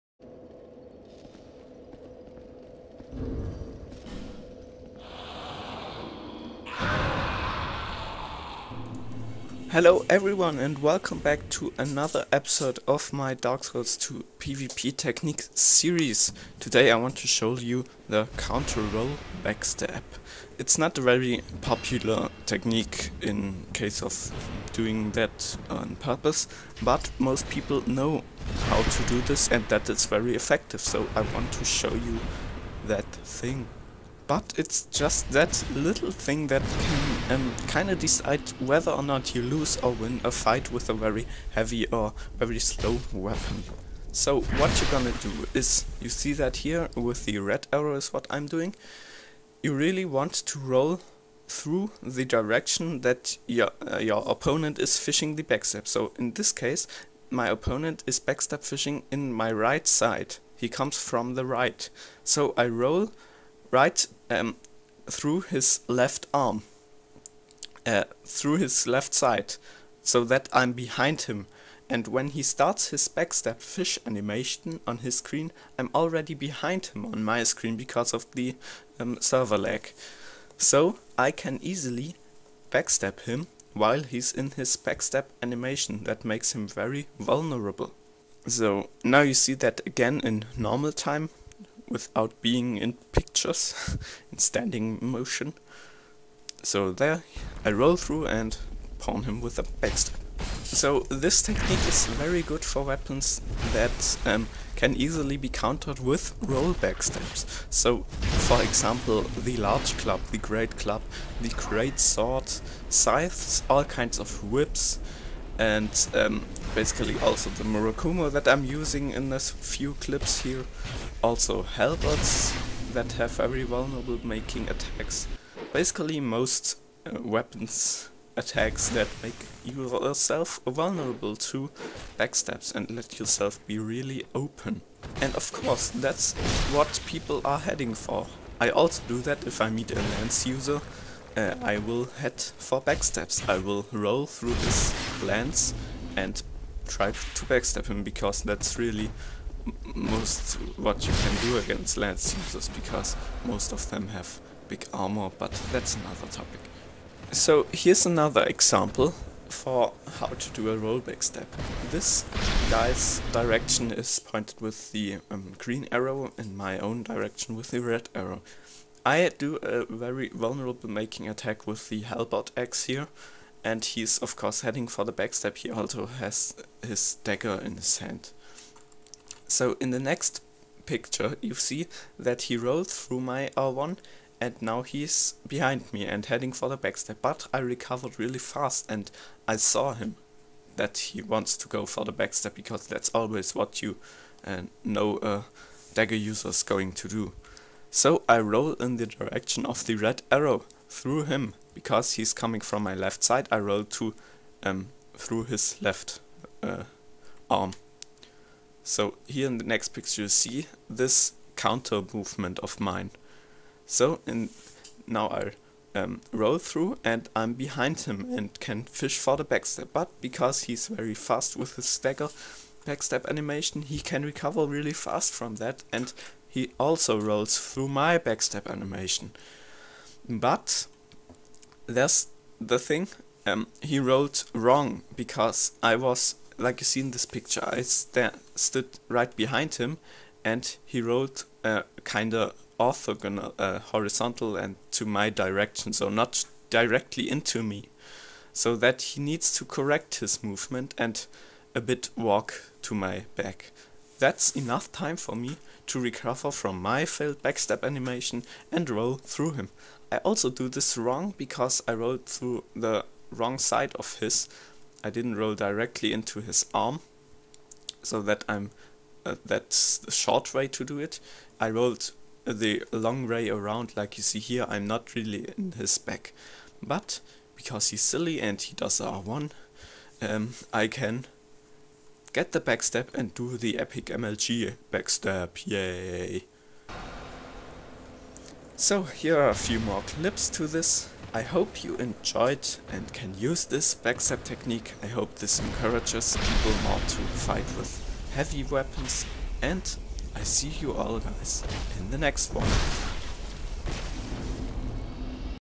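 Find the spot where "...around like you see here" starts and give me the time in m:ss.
4:33.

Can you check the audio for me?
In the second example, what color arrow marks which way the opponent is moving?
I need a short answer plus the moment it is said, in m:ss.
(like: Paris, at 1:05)
green, at 2:45.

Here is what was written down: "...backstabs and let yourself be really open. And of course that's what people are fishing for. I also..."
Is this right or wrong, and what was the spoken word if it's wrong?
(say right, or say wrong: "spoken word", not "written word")
wrong: "heading", not "fishing".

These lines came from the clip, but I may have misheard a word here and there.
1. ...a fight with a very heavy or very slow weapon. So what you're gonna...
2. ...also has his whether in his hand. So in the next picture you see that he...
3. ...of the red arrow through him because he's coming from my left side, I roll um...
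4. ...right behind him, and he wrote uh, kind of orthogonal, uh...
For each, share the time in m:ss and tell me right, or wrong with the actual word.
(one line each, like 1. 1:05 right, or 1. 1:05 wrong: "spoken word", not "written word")
1. 0:40 right
2. 2:55 wrong: "dagger", not "whether"
3. 3:19 right
4. 3:59 right.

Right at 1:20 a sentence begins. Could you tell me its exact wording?
So I can easily backstab him while he's in his backstab animation.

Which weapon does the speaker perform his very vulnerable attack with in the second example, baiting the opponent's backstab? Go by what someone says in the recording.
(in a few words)
halberd axe.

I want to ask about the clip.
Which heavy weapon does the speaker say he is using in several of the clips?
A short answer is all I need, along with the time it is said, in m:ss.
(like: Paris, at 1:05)
Murakumo, at 1:57.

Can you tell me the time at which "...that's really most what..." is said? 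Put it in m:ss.
2:28.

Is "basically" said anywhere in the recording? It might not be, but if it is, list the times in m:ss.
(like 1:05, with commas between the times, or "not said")
1:56, 2:05.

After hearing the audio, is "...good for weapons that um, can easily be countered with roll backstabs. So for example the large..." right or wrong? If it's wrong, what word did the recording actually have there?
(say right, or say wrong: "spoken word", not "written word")
right.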